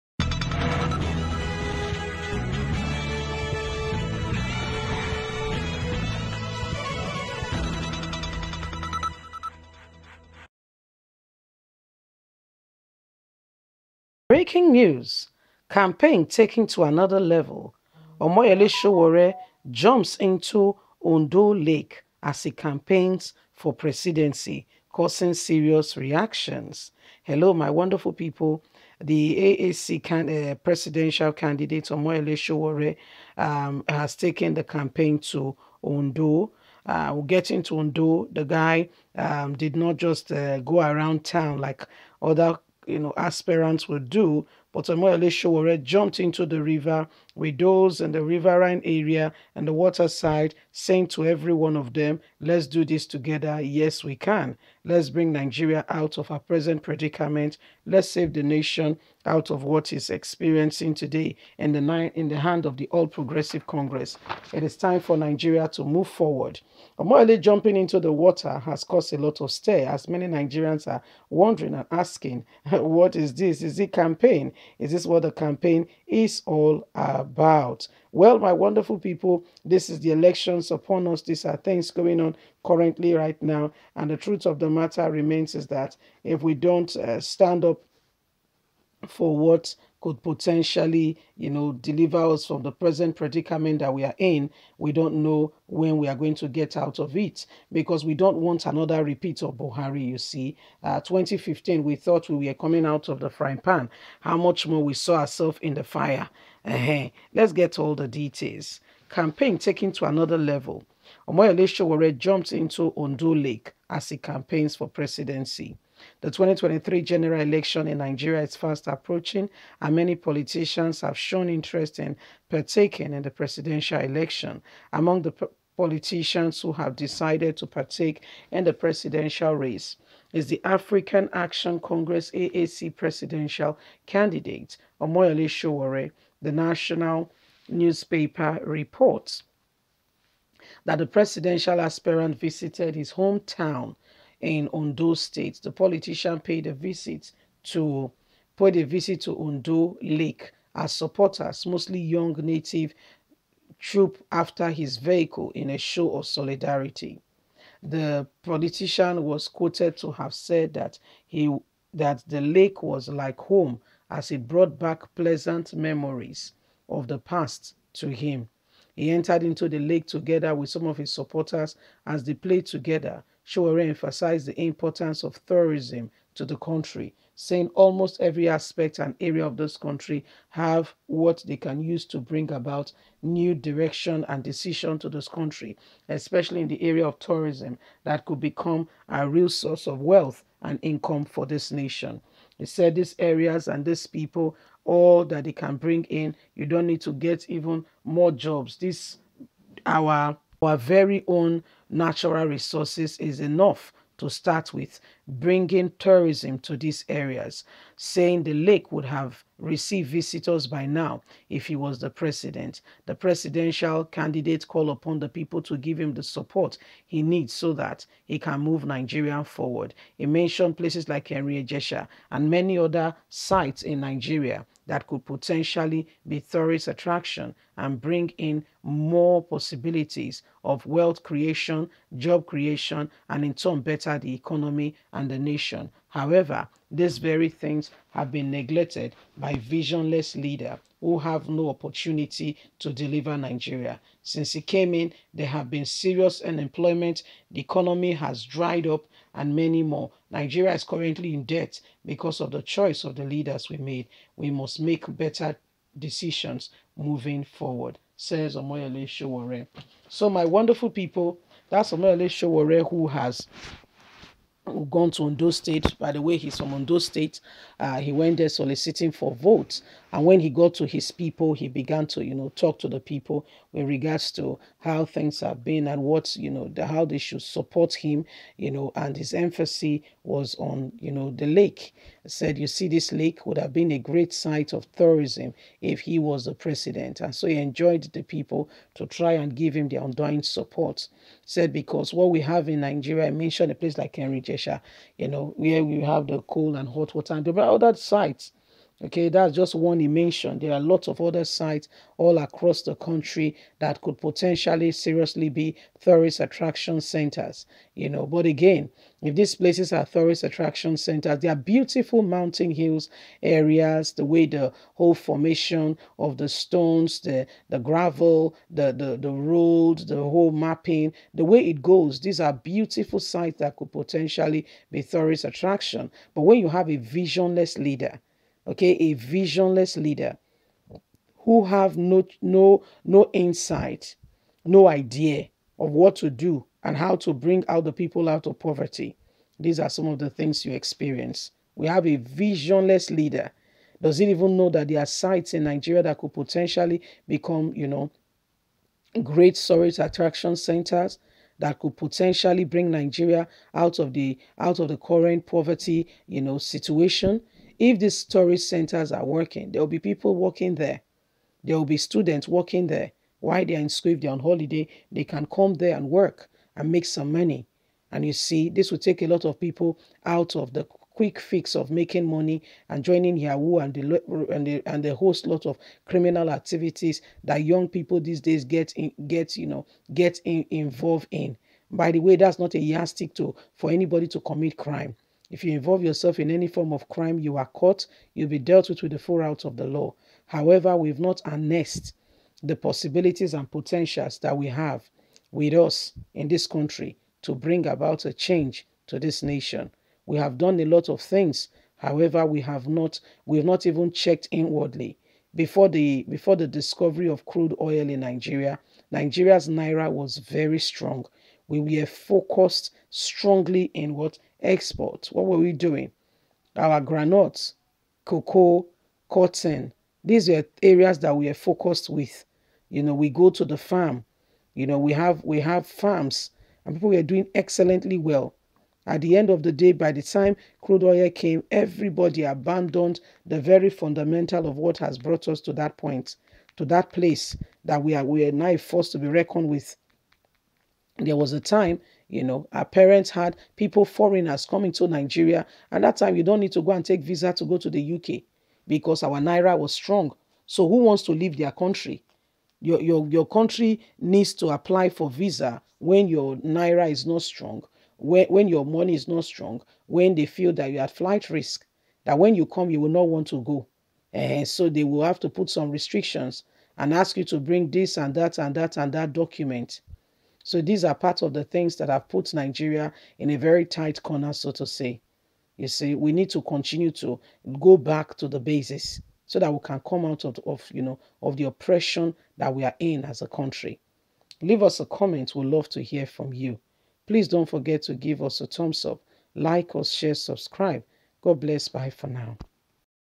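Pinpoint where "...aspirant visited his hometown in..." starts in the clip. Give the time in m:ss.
2:21.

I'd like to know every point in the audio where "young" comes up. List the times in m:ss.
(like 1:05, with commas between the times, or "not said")
2:31, 6:17.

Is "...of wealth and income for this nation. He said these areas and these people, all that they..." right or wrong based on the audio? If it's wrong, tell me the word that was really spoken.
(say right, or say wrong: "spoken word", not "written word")
right.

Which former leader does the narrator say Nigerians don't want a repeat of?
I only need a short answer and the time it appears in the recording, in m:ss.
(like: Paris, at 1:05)
Buhari, at 1:39.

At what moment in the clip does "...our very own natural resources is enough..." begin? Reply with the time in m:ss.
3:20.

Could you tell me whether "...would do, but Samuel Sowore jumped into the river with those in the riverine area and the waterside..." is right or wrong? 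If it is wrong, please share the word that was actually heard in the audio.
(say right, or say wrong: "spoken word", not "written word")
right.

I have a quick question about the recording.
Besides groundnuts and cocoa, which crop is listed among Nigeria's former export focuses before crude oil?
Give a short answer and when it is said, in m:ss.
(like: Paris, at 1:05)
Cotton, at 6:59.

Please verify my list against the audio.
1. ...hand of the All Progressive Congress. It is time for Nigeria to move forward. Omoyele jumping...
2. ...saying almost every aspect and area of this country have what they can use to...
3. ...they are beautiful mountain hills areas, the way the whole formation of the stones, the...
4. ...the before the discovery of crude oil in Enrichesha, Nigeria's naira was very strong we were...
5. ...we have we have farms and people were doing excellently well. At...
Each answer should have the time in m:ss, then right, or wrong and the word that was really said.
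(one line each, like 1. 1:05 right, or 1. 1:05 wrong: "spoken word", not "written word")
1. 1:02 right
2. 2:57 right
3. 5:11 right
4. 6:45 wrong: "Nigeria", not "Enrichesha"
5. 7:04 right.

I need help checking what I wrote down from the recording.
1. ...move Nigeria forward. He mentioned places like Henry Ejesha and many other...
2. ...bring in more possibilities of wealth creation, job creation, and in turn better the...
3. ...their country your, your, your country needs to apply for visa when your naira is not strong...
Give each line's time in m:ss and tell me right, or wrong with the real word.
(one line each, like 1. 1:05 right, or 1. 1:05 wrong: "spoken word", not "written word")
1. 3:38 right
2. 3:48 right
3. 7:31 right.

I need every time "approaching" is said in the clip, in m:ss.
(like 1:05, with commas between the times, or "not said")
1:58.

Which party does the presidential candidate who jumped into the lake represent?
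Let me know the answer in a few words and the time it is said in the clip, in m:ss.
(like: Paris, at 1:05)
African Action Congress, at 2:10.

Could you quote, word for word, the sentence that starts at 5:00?
There are lots of other sites all across the country that could potentially seriously be tourist attraction centers, you know.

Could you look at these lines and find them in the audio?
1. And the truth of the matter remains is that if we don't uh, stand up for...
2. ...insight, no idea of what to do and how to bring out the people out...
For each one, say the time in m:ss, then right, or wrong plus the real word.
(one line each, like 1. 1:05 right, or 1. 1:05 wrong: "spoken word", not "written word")
1. 1:23 right
2. 5:33 right.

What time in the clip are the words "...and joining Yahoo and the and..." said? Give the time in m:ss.
6:12.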